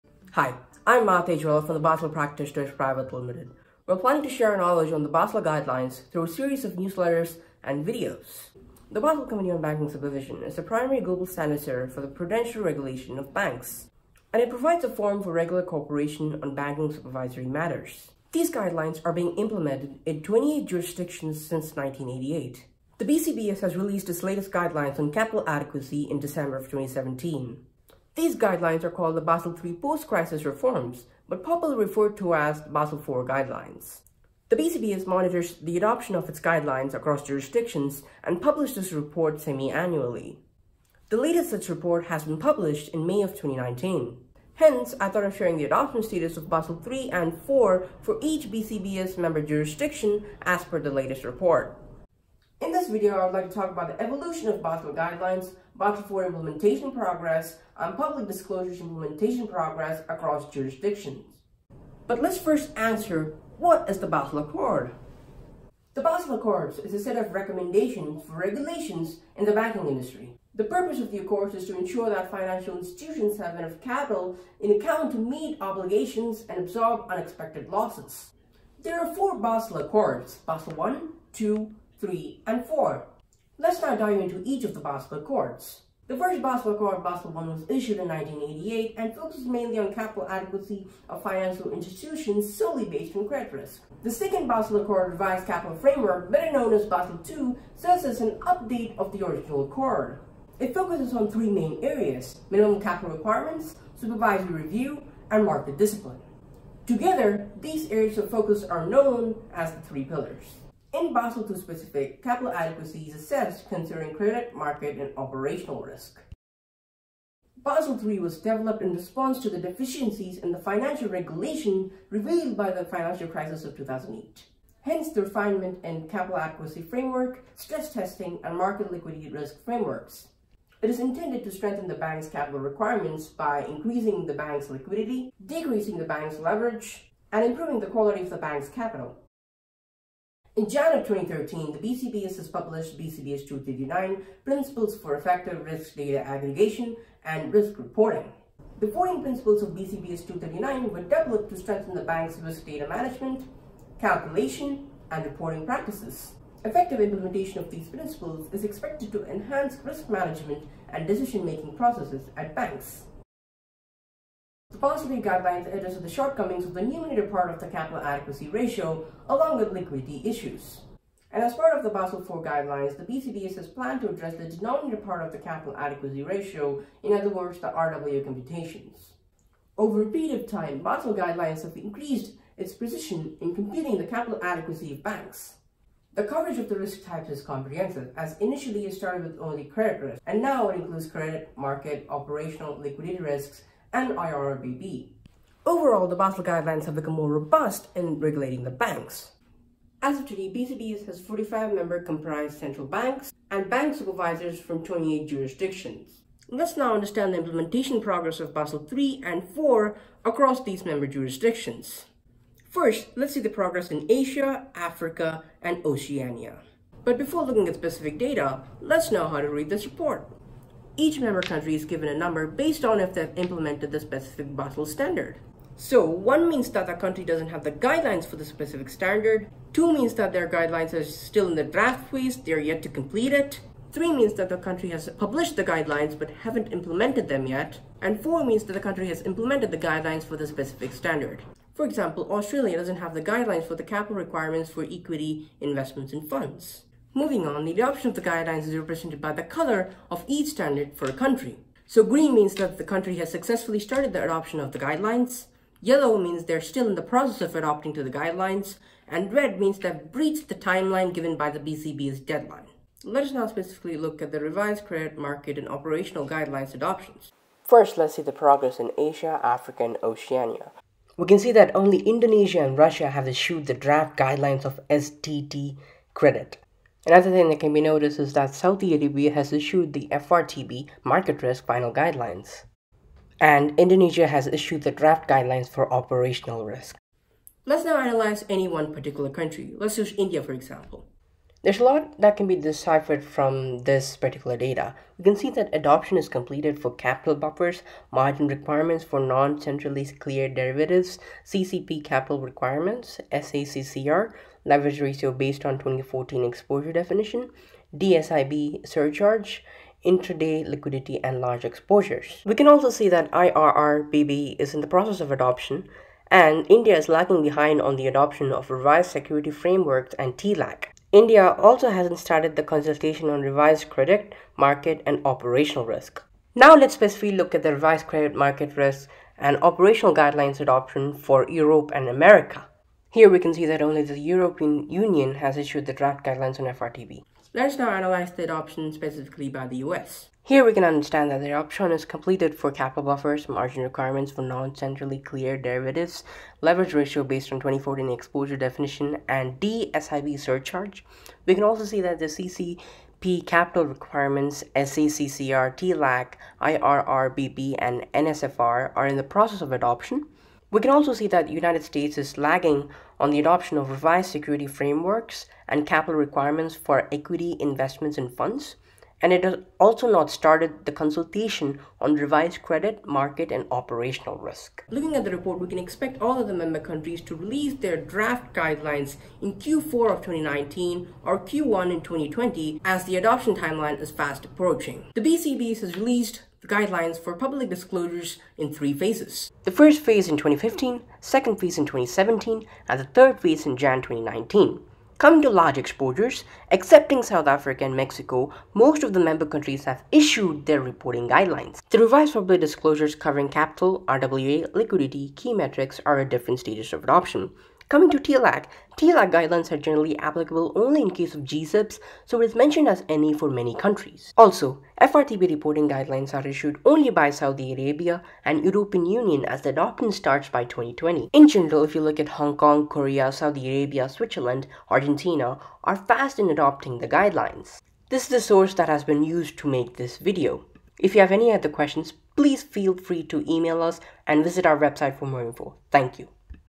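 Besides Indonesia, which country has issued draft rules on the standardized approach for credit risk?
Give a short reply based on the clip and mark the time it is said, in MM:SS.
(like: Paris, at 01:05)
Russia, at 04:32.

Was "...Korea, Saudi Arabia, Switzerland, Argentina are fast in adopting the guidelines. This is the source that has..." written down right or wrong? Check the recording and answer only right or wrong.
right.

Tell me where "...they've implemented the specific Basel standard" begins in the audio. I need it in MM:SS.
03:43.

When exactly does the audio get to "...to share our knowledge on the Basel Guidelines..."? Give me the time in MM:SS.
00:04.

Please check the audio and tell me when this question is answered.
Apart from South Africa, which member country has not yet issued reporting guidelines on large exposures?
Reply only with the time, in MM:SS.
06:37.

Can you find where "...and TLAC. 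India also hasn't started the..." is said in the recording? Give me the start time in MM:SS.
05:20.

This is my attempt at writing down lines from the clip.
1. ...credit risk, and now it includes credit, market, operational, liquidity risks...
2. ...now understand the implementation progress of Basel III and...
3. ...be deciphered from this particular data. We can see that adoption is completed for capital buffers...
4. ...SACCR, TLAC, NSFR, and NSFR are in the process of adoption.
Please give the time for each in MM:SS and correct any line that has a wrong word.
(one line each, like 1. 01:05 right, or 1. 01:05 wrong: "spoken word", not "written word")
1. 03:09 right
2. 03:26 right
3. 04:52 right
4. 05:54 wrong: "IRRBB", not "NSFR".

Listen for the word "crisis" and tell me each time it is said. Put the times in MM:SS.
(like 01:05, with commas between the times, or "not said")
00:29, 02:03.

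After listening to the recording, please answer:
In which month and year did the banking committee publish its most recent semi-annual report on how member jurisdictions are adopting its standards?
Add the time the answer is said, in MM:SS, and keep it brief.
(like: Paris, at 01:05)
May 2019, at 00:43.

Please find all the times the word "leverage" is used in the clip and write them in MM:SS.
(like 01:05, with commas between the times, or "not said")
02:16, 05:04, 05:46.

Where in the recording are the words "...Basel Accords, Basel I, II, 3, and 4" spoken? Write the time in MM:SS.
01:19.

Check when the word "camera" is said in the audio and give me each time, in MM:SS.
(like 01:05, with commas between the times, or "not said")
not said.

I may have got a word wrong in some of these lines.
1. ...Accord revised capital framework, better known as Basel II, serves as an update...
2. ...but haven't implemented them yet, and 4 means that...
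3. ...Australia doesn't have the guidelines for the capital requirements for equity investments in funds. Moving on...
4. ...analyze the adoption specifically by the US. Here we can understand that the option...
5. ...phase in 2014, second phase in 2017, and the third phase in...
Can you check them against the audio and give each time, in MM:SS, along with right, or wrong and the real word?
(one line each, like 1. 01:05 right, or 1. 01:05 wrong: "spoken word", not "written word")
1. 01:34 right
2. 03:56 right
3. 04:02 right
4. 05:37 right
5. 06:30 wrong: "2015", not "2014".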